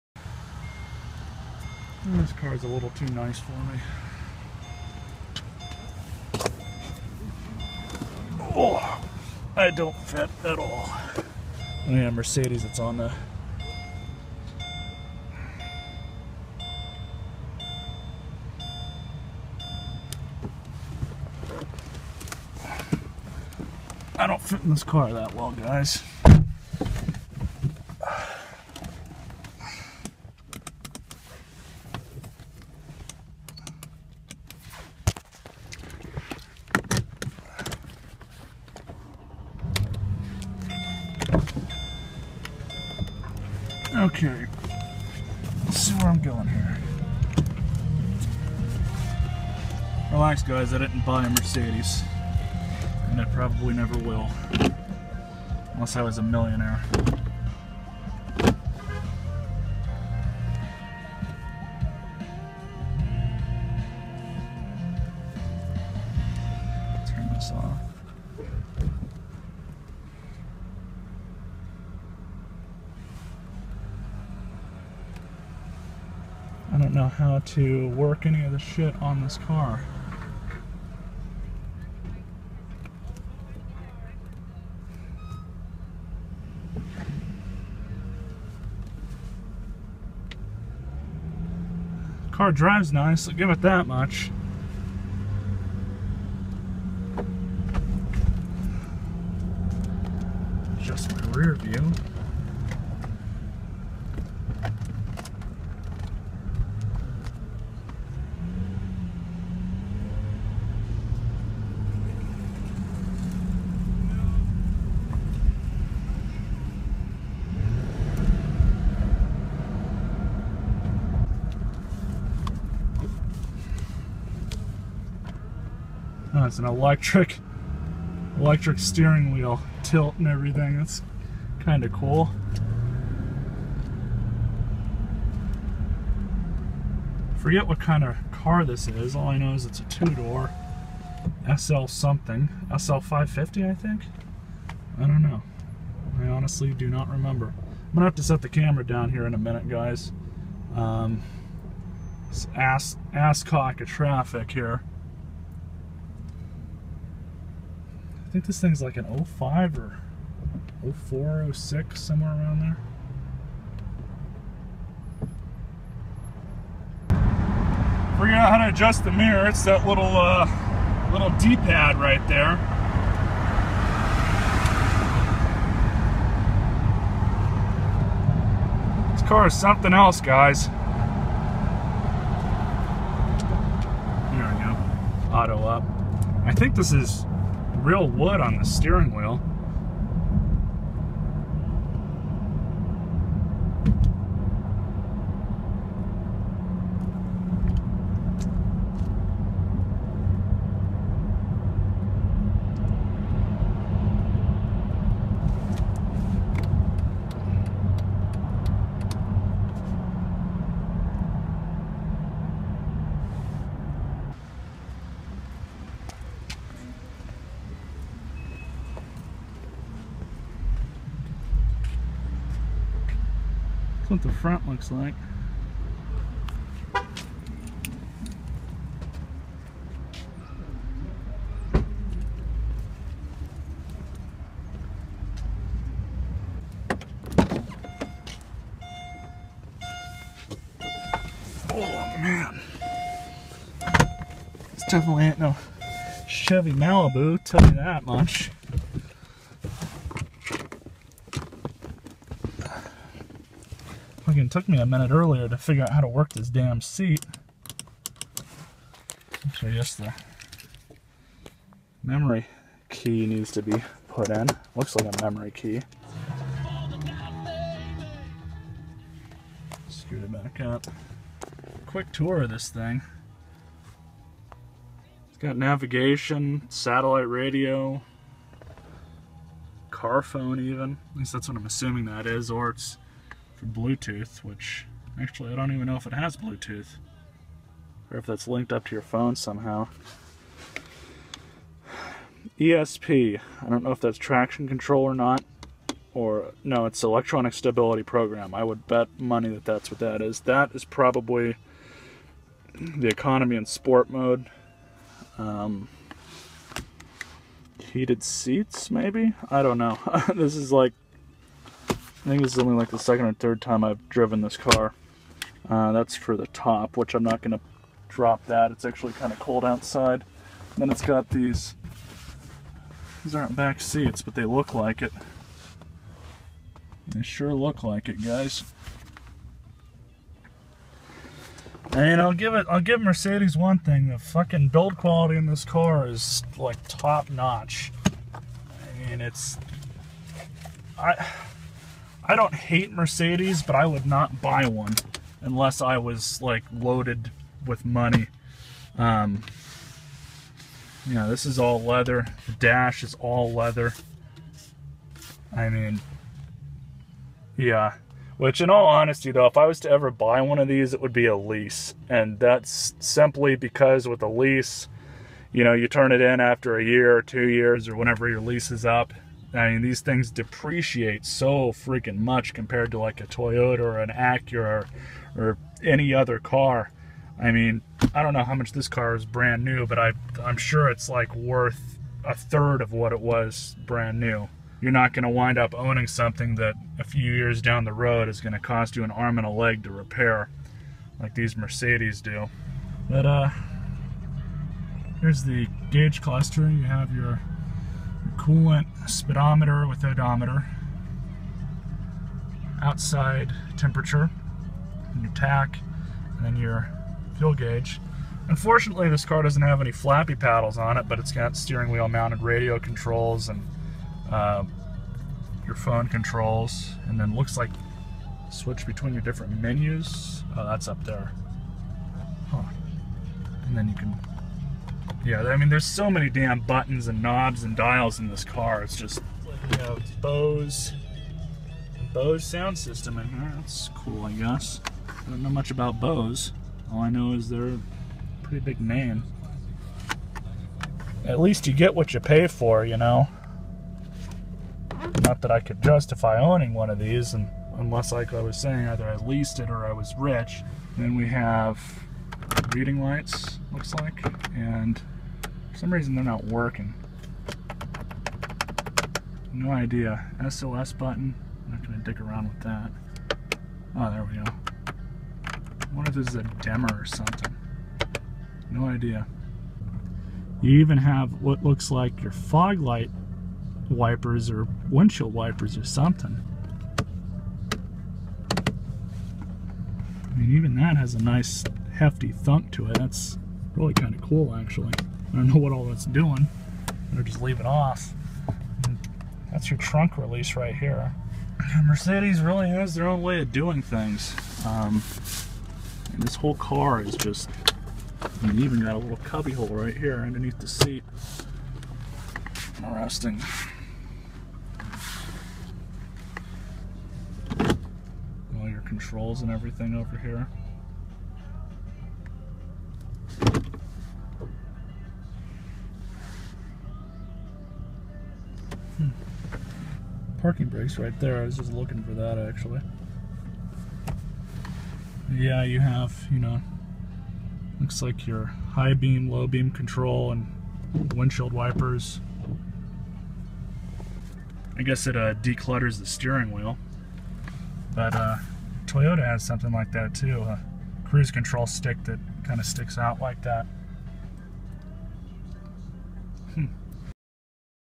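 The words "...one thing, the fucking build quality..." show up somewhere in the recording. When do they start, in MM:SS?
05:33.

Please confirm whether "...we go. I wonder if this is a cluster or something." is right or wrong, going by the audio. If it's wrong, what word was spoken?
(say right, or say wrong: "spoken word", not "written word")
wrong: "dimmer", not "cluster".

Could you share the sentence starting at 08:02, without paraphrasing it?
That's really kind of cool, actually.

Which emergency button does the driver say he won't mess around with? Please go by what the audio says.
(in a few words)
SOS button.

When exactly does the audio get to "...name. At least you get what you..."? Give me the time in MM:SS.
07:18.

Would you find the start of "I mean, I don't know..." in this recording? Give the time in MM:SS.
06:17.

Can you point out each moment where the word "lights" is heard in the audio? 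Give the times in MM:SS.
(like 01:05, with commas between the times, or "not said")
07:33, 07:52.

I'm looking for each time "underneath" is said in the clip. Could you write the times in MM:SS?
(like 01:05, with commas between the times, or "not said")
08:20.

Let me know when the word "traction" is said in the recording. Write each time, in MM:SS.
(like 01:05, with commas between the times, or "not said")
04:54.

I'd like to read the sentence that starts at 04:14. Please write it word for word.
Fucking took me a minute earlier to figure out how to work this damn seat.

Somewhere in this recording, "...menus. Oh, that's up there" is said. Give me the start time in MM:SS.
06:59.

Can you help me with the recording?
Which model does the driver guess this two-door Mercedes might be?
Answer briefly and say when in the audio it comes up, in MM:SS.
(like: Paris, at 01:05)
SL 550, at 02:22.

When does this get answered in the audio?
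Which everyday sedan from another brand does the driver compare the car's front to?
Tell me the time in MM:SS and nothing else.
04:06.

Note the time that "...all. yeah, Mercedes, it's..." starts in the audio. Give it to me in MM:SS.
00:10.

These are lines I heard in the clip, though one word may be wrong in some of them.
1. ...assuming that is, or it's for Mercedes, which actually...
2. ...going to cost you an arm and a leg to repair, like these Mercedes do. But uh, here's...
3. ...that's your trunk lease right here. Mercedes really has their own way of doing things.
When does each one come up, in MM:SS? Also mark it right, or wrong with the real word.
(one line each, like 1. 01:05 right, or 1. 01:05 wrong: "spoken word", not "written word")
1. 04:41 wrong: "Bluetooth", not "Mercedes"
2. 06:28 right
3. 08:09 wrong: "release", not "lease".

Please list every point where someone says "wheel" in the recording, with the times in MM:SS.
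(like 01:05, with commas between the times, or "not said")
02:09, 03:09, 06:51, 08:56.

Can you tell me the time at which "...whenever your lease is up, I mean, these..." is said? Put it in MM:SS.
06:07.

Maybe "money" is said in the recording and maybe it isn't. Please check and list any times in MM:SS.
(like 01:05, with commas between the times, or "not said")
04:59, 05:47.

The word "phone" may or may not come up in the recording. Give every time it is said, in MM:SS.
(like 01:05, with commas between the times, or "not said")
04:40, 04:49, 06:55.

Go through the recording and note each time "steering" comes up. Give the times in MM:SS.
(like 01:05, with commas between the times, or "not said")
02:08, 03:08, 06:51, 08:56.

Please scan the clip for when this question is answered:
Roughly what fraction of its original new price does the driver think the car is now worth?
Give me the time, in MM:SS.
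06:22.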